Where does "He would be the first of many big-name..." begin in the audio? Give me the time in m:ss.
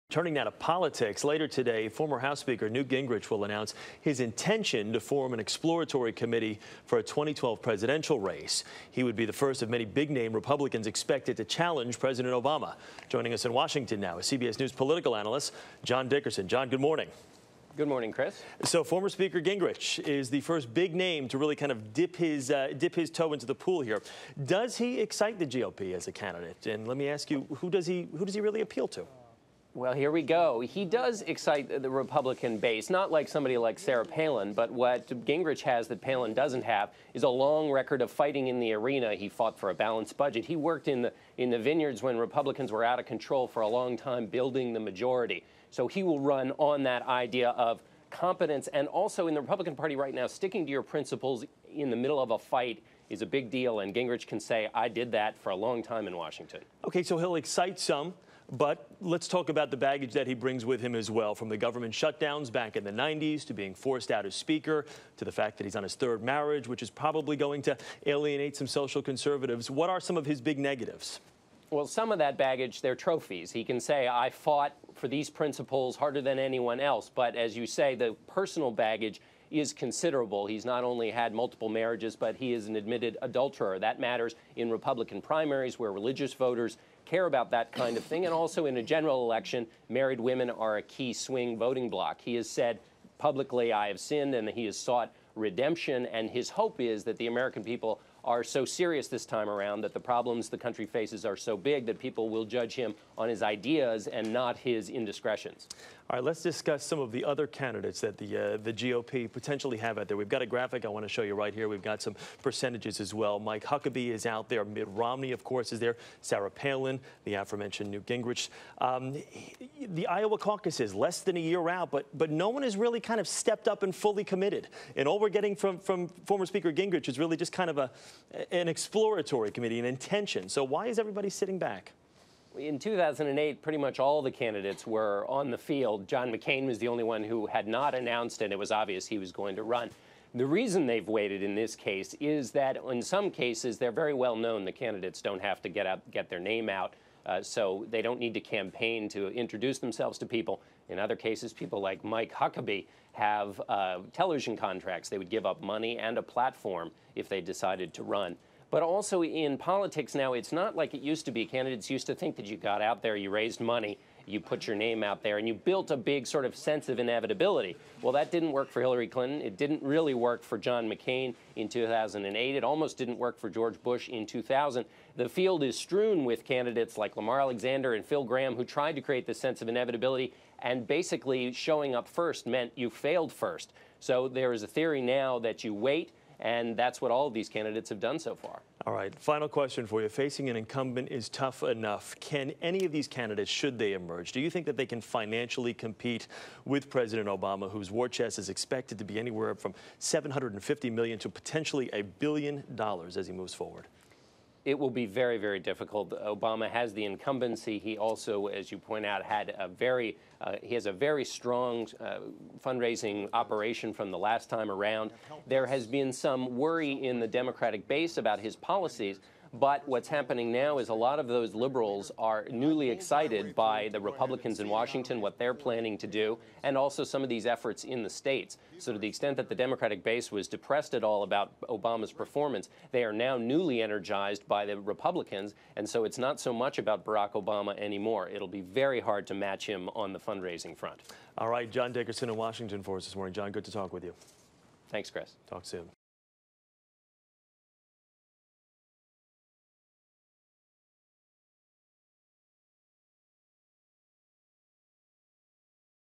0:08.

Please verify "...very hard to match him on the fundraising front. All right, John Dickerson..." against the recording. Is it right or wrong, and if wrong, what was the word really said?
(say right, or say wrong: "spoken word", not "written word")
right.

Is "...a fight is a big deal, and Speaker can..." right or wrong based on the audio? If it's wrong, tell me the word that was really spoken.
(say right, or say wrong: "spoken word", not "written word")
wrong: "Gingrich", not "Speaker".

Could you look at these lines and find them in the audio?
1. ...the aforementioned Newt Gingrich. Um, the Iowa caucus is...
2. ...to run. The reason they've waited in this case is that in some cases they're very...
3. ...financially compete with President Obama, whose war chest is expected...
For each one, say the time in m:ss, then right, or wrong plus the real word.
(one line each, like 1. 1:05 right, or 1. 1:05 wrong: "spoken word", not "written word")
1. 1:57 right
2. 2:19 right
3. 3:15 right.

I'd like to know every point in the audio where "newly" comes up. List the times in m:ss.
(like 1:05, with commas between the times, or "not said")
3:42, 3:53.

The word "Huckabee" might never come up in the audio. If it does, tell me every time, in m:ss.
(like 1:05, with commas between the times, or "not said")
1:53, 2:32.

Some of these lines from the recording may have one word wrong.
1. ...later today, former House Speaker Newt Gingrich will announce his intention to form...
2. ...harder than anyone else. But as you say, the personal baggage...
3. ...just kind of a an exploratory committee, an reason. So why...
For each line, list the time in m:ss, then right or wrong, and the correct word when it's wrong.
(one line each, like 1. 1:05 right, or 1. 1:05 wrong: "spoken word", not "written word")
1. 0:01 right
2. 1:15 right
3. 2:07 wrong: "intention", not "reason".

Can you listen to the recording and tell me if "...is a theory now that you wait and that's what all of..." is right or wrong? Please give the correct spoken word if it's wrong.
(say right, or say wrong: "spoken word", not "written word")
right.